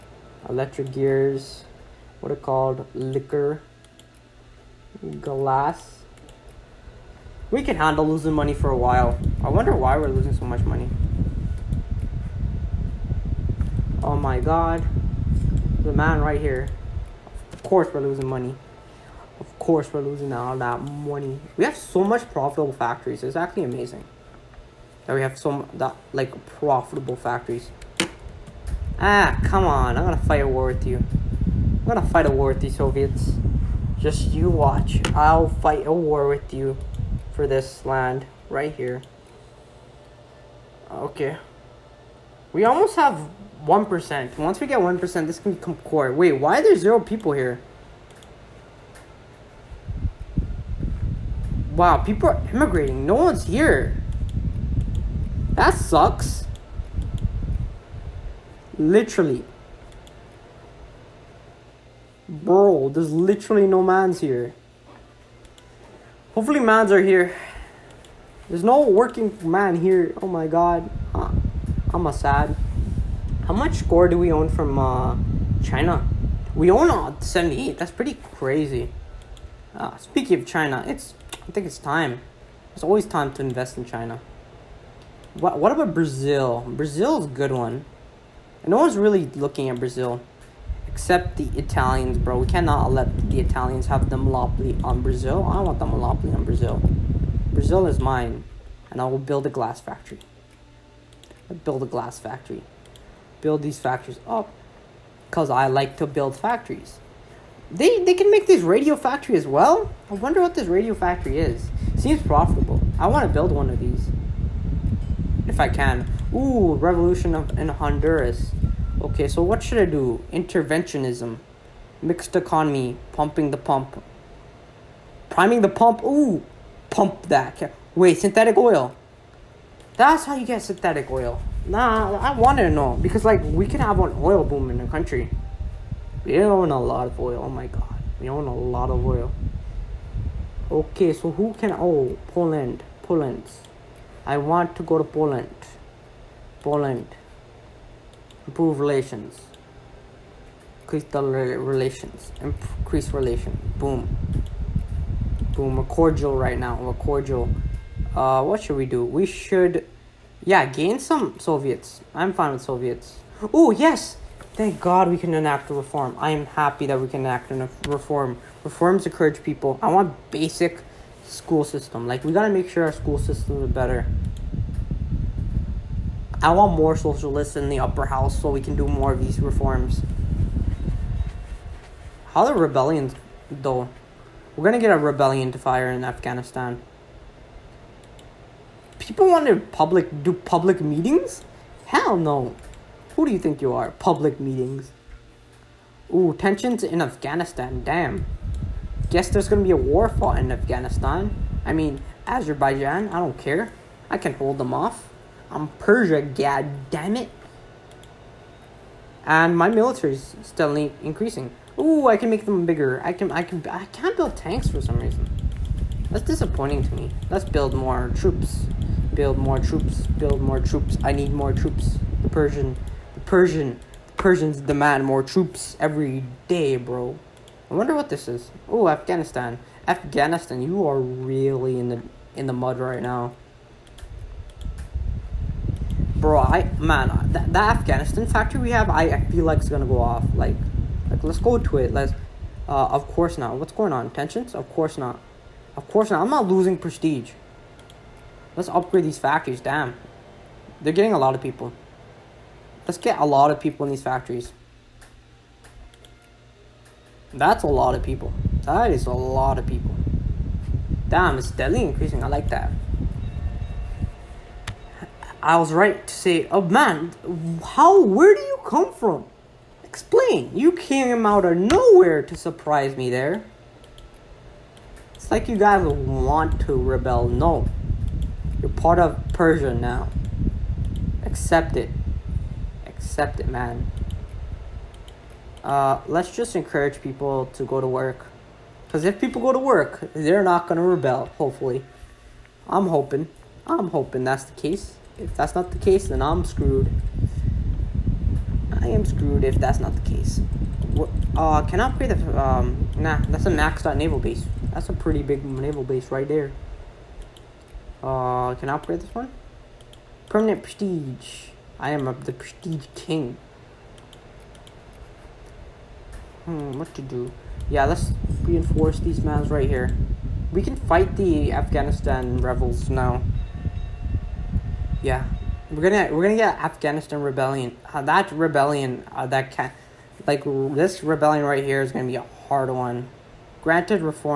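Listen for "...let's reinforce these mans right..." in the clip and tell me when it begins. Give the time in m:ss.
5:17.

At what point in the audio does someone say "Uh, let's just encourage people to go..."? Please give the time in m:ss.
4:45.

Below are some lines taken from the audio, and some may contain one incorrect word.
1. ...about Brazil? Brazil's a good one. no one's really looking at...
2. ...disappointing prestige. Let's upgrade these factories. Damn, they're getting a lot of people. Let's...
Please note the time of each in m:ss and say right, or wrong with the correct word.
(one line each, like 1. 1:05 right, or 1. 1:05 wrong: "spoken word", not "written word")
1. 1:25 right
2. 4:06 wrong: "losing", not "disappointing".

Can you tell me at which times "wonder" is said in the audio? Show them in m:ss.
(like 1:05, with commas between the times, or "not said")
0:09, 1:50, 3:47.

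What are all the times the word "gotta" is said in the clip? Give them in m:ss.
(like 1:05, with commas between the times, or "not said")
2:52.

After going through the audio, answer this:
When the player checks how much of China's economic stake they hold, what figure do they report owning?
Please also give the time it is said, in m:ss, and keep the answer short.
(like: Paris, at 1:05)
78, at 1:17.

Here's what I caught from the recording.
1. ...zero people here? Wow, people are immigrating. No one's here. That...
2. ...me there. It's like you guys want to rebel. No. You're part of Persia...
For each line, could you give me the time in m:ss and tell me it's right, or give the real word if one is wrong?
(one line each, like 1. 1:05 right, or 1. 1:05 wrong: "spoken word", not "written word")
1. 0:46 right
2. 4:32 right.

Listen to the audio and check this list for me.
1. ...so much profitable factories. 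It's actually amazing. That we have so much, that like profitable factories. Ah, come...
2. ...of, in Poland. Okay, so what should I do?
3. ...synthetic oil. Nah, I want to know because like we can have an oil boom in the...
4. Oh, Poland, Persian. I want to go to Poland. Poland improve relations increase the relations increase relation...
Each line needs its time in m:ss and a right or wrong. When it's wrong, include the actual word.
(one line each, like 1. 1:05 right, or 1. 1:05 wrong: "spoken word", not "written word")
1. 0:21 right
2. 1:57 wrong: "Honduras", not "Poland"
3. 2:10 right
4. 2:21 wrong: "Poland", not "Persian".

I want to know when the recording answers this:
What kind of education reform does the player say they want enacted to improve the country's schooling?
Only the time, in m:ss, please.
2:50.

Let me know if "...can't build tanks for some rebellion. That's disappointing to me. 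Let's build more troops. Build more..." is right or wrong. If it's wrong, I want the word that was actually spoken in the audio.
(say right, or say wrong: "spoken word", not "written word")
wrong: "reason", not "rebellion".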